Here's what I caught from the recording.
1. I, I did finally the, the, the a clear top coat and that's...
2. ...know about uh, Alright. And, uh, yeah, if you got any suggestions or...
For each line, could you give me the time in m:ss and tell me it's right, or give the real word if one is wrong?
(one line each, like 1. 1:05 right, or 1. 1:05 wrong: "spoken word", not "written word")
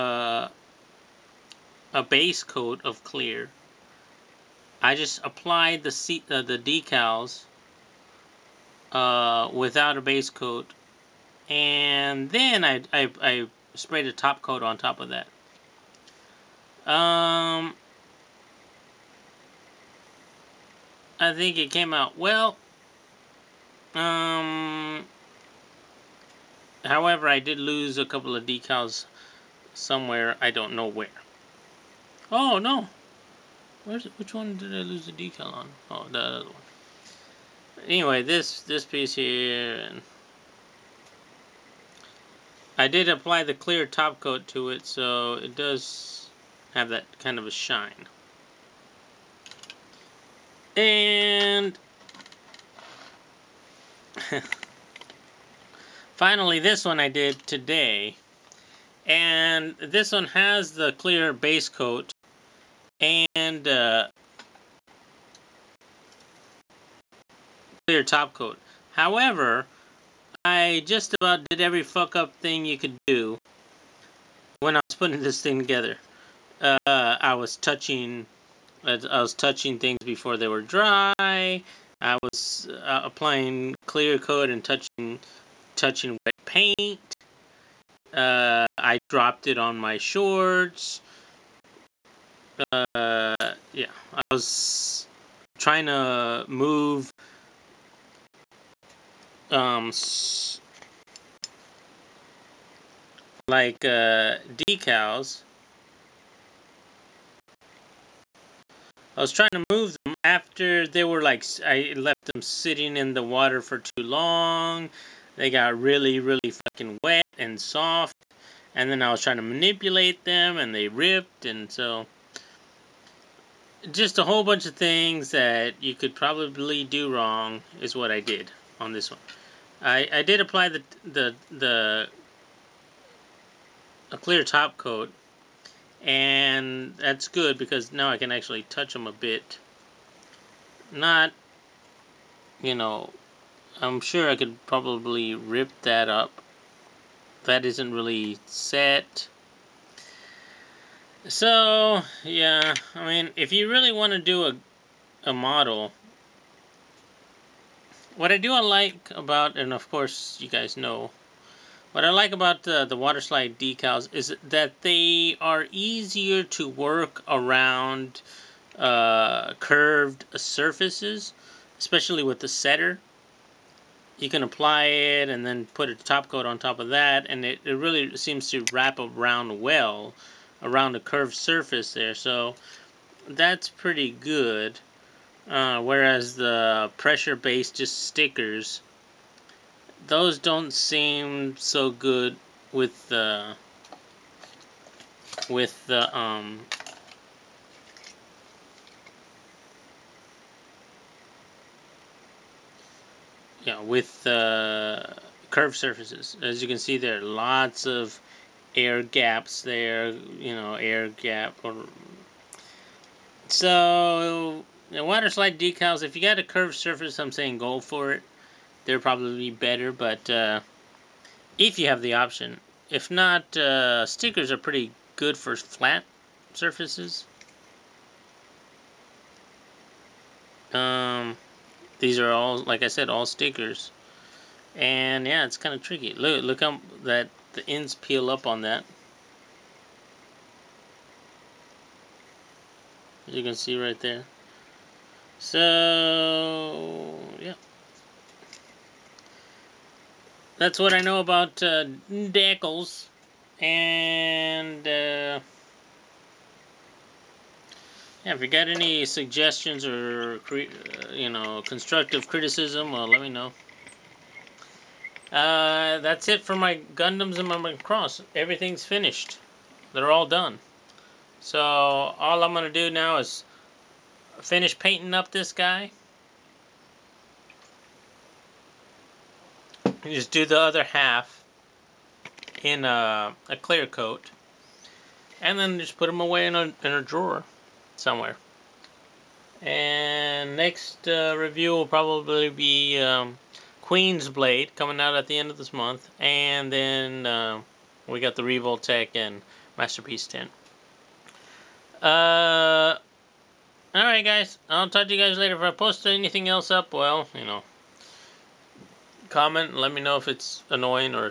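1. 2:09 wrong: "apply", not "finally"
2. 4:10 wrong: "Dackles", not "Alright".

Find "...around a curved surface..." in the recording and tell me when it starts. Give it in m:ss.
3:00.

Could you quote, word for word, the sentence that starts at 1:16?
Uh, I was touching, I was touching things before they were dry.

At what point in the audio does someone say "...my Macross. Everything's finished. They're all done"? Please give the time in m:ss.
4:27.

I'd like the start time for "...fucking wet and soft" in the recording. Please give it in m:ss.
1:56.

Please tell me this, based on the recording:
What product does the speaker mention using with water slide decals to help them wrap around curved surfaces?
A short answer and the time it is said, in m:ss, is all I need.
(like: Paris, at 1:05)
The setter, at 2:52.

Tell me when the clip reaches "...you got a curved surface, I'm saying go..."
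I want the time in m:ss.
3:36.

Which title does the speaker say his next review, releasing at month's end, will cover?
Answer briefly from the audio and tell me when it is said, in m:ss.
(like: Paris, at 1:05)
Queen's Blade, at 4:53.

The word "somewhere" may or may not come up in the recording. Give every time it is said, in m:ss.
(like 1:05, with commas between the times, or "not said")
0:29, 4:47.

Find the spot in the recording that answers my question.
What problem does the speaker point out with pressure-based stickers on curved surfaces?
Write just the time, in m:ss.
3:28.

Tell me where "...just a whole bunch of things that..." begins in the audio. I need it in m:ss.
2:03.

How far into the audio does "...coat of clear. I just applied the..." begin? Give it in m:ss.
0:02.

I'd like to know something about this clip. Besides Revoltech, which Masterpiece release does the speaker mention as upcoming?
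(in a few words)
Masterpiece 10.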